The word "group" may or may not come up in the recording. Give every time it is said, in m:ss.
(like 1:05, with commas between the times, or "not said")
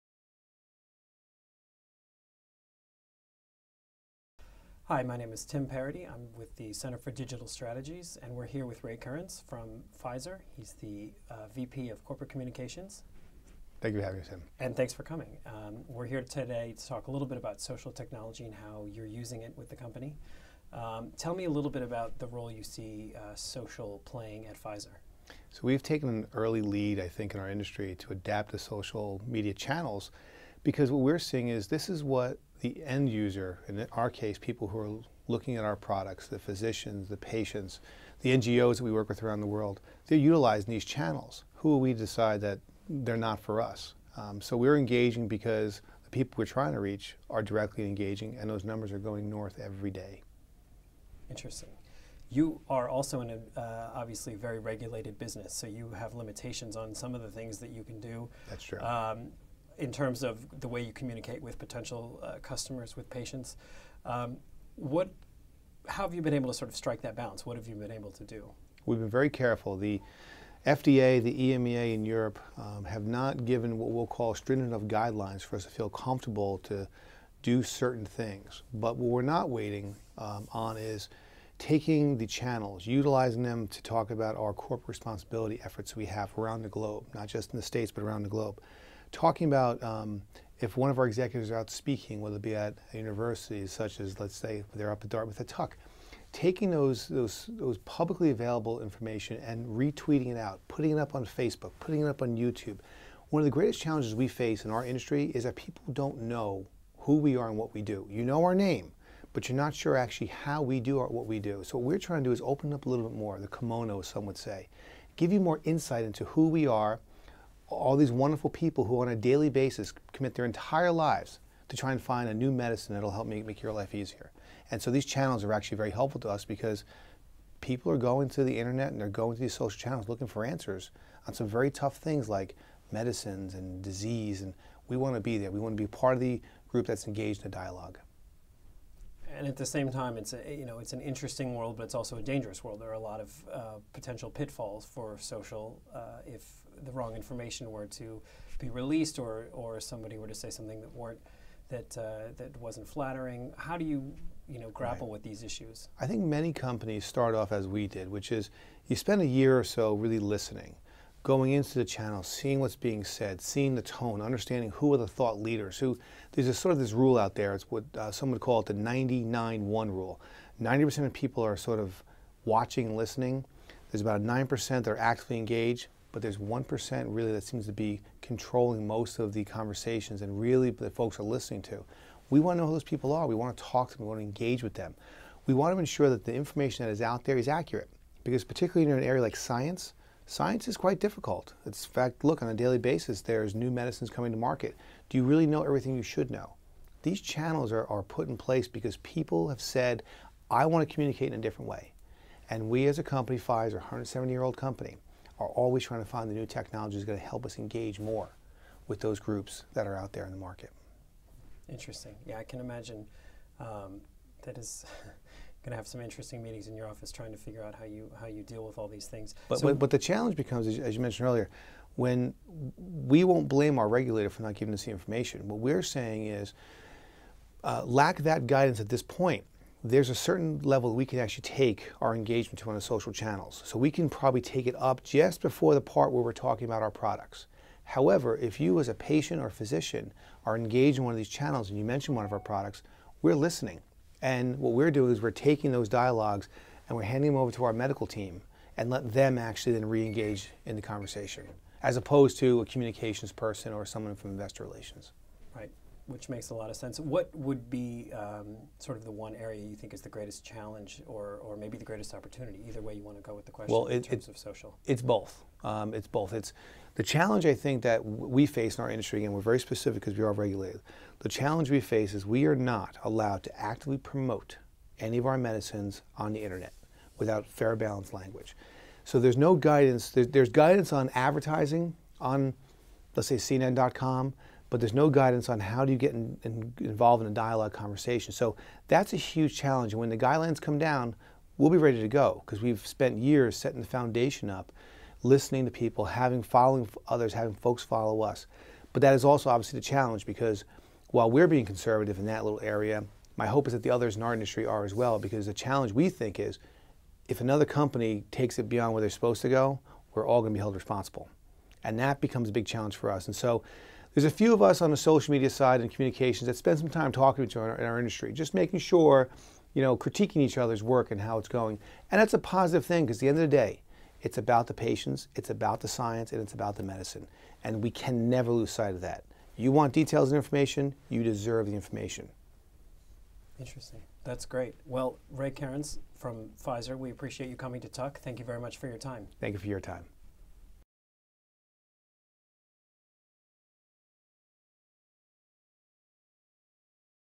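2:16, 3:29.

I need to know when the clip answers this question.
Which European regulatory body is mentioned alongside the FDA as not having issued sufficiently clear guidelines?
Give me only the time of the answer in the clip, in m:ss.
1:11.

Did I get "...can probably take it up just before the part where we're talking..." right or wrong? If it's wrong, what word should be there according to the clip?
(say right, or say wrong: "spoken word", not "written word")
right.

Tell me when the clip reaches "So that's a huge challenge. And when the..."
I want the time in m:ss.
4:48.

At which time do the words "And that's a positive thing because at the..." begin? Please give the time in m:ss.
5:22.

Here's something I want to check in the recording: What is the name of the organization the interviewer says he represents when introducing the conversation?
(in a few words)
Center for Digital Strategies.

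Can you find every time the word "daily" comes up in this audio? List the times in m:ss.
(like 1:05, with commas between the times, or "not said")
1:59, 3:12.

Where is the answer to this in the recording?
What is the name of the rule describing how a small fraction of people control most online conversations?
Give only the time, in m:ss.
2:48.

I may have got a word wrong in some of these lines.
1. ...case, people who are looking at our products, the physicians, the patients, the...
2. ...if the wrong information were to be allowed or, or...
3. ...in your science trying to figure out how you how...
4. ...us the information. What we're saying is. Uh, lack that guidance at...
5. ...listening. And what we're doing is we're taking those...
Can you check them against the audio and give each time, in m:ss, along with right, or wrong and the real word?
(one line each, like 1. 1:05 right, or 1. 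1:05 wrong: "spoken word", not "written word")
1. 0:34 right
2. 2:26 wrong: "released", not "allowed"
3. 3:36 wrong: "office", not "science"
4. 3:44 right
5. 4:03 right.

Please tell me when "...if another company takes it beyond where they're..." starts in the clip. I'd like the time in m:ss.
5:07.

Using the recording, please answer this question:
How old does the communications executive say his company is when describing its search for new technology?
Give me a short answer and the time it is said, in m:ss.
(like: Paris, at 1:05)
170 years, at 3:23.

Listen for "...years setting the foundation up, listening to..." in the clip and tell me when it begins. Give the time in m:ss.
4:53.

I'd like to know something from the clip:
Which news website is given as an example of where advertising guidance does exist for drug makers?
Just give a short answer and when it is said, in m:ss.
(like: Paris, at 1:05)
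CNN.com, at 4:43.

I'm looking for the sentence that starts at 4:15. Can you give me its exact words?
Right which makes a lot of sense.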